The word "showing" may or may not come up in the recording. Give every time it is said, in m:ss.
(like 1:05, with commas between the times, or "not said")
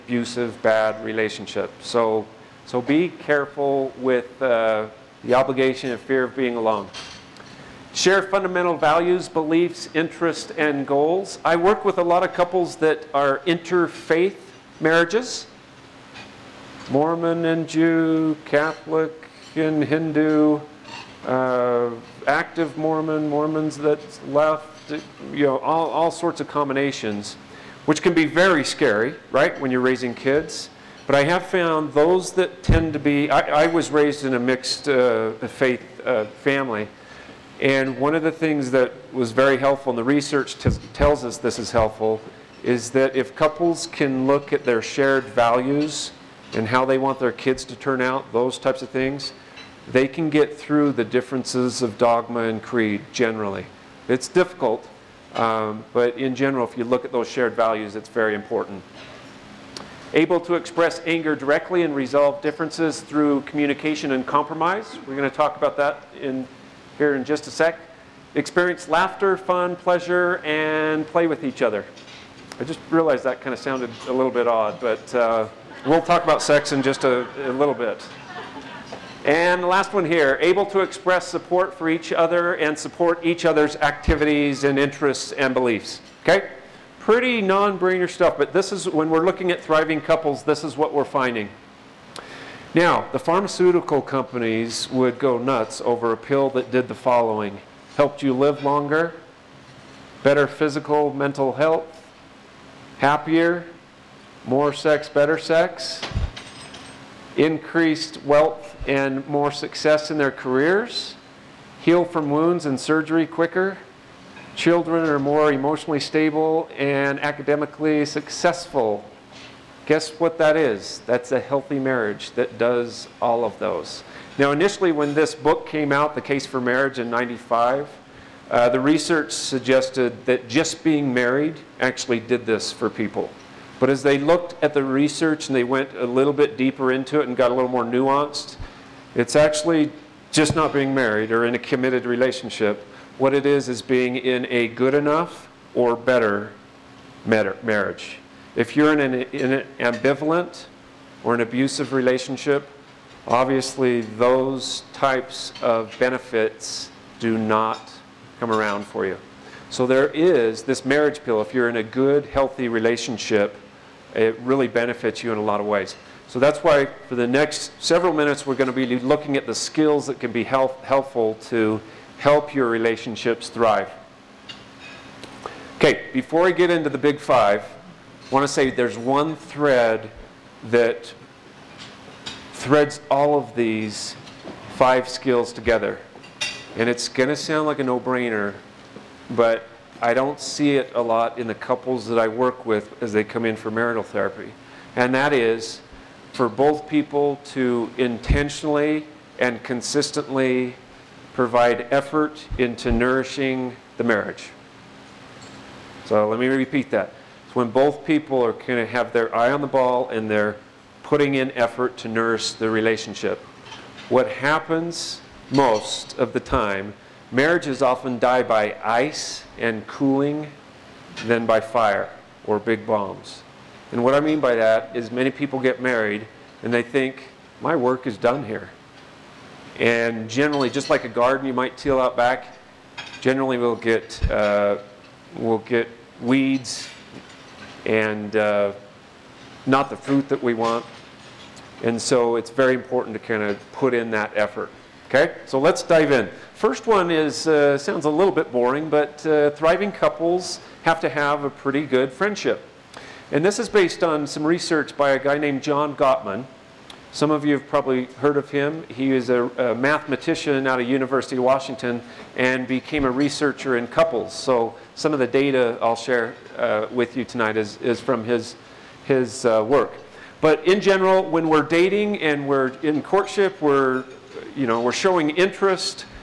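4:34.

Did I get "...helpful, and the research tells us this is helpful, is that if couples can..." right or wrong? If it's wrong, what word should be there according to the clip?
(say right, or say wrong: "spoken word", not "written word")
right.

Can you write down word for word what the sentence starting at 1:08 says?
Experience laughter, fun, pleasure, and play with each other.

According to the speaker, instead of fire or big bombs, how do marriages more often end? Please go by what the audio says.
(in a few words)
ice and cooling.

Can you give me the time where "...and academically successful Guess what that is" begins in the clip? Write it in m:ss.
1:56.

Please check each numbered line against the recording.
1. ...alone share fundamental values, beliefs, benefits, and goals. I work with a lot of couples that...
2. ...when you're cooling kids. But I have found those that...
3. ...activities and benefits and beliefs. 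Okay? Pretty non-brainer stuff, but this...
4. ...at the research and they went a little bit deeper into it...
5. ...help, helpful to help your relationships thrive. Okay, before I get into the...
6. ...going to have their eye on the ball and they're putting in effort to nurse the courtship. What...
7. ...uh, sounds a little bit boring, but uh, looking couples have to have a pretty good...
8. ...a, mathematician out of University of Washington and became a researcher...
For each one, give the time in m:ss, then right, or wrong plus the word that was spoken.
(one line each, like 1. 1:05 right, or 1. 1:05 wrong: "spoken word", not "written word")
1. 0:06 wrong: "interests", not "benefits"
2. 0:29 wrong: "raising", not "cooling"
3. 1:23 wrong: "interests", not "benefits"
4. 2:14 right
5. 2:50 right
6. 3:28 wrong: "relationship", not "courtship"
7. 4:07 wrong: "thriving", not "looking"
8. 4:19 right.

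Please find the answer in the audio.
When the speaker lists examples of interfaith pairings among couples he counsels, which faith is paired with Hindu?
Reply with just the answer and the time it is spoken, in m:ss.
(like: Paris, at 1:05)
Catholic, at 0:18.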